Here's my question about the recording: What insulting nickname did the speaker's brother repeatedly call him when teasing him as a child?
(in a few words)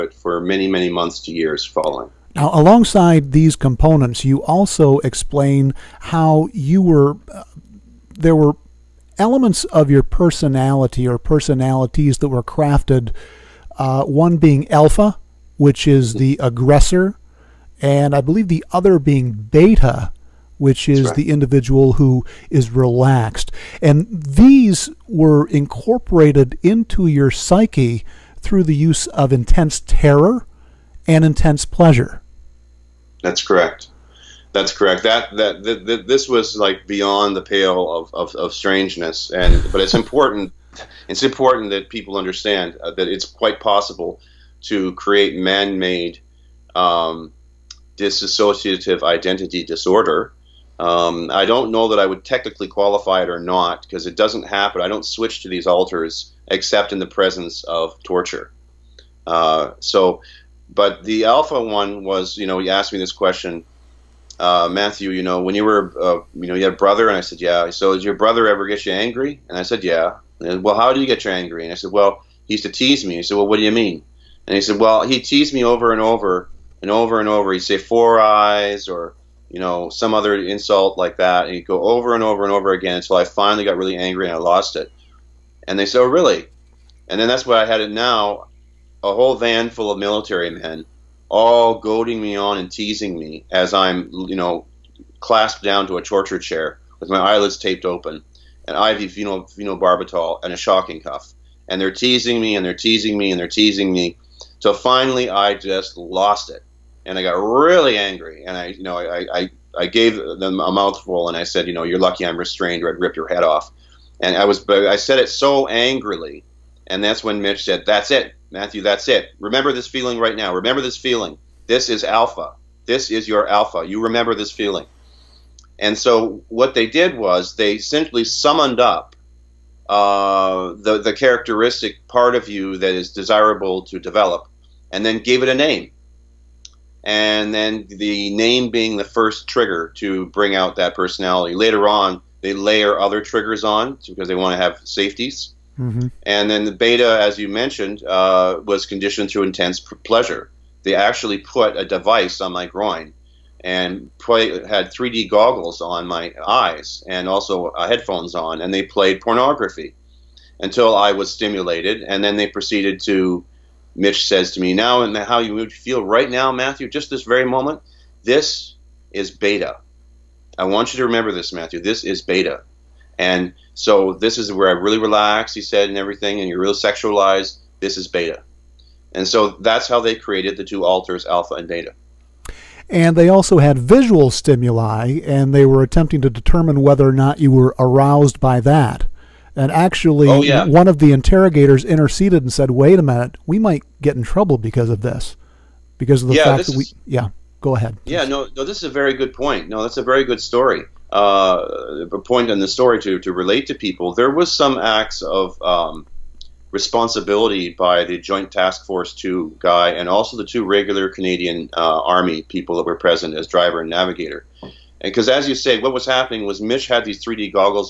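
four eyes.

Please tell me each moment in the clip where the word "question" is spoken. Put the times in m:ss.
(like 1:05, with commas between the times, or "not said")
1:03.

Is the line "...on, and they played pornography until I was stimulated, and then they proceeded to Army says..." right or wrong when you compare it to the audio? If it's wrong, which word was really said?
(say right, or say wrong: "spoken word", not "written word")
wrong: "Mitch", not "Army".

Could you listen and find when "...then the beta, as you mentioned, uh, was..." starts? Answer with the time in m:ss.
2:26.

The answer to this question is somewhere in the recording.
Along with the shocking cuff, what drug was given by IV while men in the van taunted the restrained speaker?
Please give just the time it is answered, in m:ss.
1:39.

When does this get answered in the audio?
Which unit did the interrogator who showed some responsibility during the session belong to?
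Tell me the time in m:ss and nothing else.
3:28.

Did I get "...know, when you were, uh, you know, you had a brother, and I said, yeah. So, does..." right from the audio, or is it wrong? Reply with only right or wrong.
right.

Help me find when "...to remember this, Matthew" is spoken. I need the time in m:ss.
2:50.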